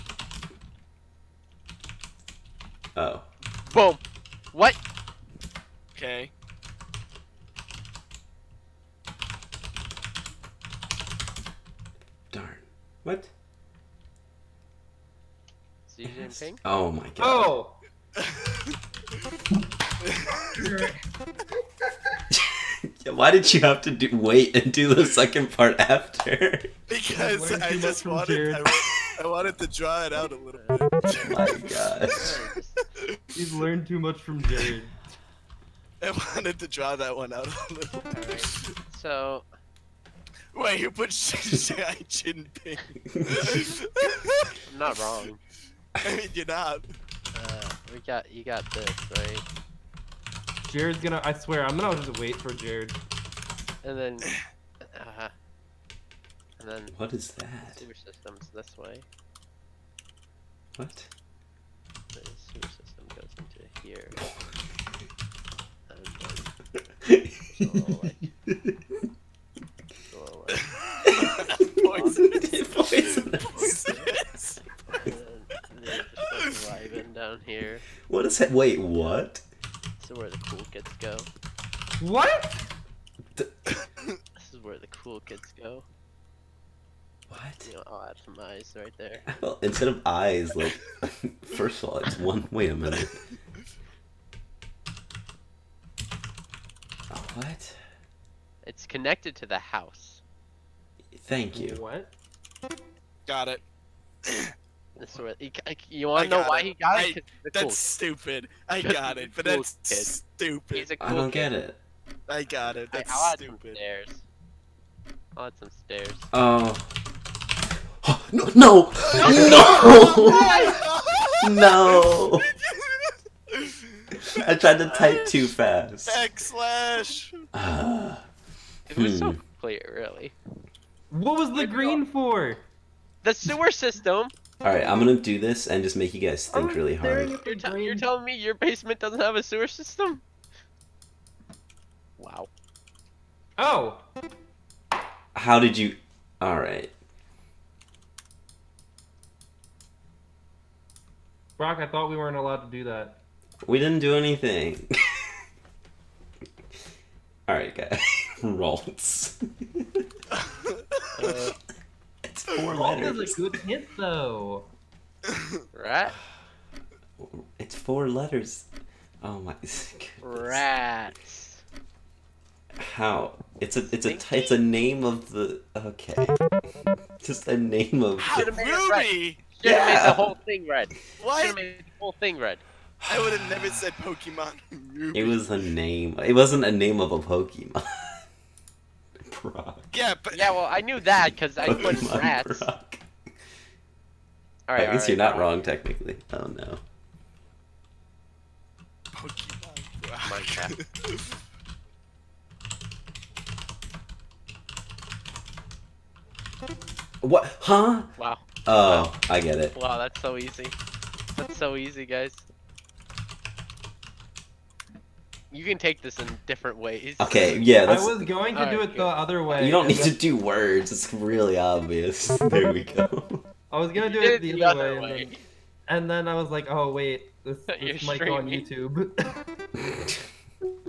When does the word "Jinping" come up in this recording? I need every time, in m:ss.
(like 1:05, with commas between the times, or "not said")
0:42.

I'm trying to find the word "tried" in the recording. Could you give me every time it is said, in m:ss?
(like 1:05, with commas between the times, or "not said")
2:04.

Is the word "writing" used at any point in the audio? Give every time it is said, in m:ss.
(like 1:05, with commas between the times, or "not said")
not said.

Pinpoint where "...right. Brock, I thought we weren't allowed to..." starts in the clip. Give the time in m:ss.
2:26.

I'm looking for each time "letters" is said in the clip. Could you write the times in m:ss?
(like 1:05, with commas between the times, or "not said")
2:42, 2:48.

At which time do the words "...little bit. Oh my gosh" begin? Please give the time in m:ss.
0:30.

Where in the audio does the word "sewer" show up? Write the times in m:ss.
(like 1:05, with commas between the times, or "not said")
0:57, 1:02, 2:13, 2:19.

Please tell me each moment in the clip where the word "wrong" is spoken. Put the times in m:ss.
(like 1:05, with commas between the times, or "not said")
0:44, 3:15.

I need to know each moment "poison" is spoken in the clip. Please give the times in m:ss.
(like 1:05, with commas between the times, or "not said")
1:16.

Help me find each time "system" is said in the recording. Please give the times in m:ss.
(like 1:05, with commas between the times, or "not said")
0:57, 1:02, 2:13, 2:19.